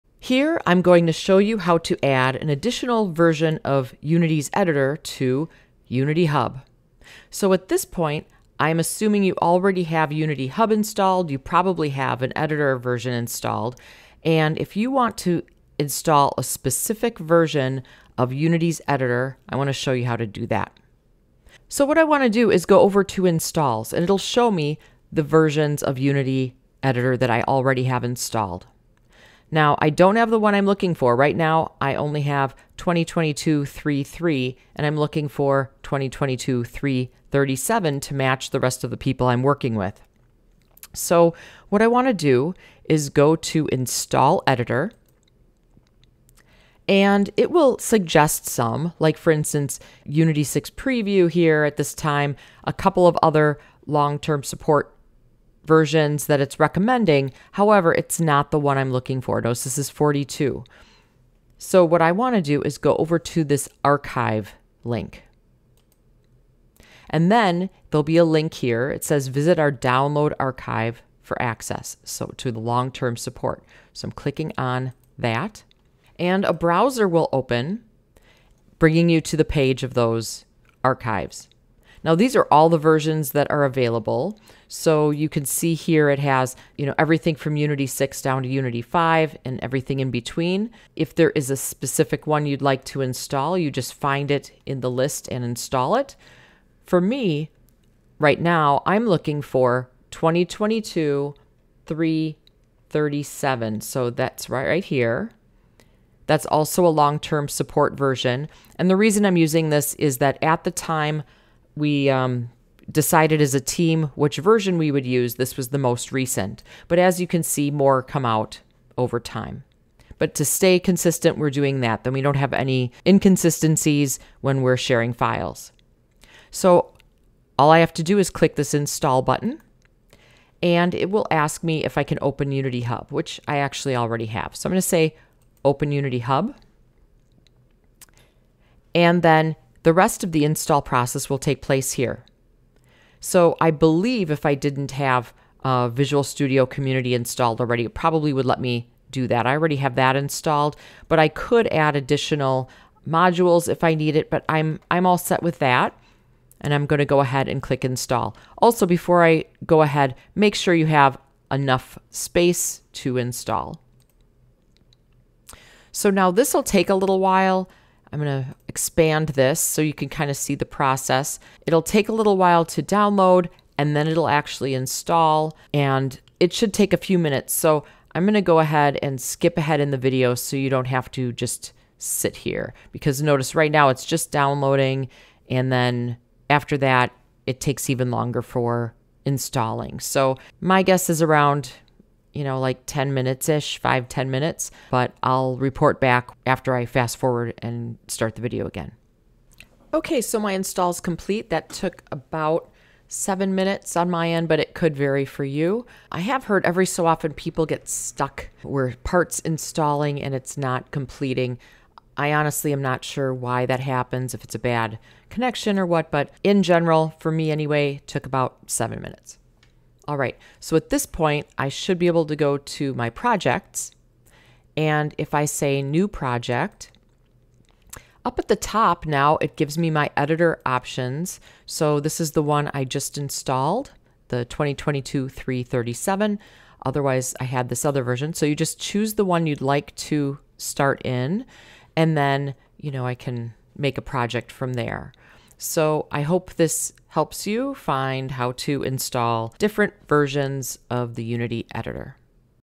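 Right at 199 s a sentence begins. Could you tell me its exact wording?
Okay, so my install is complete.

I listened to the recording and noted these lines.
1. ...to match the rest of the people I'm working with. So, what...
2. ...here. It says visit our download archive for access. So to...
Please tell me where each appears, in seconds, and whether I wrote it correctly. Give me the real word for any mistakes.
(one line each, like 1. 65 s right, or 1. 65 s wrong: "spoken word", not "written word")
1. 37 s right
2. 68 s right.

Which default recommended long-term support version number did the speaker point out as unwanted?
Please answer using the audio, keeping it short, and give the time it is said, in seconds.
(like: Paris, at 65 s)
42, at 59 s.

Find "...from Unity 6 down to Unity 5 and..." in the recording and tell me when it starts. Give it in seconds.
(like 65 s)
87 s.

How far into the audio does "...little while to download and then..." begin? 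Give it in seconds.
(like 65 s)
172 s.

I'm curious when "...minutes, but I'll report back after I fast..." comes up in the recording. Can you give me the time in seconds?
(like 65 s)
194 s.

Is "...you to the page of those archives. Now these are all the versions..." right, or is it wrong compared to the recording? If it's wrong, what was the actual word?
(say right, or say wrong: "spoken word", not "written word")
right.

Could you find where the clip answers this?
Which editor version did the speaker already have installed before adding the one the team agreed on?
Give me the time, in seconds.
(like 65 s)
32 s.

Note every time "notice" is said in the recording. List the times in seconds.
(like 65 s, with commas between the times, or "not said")
59 s, 183 s.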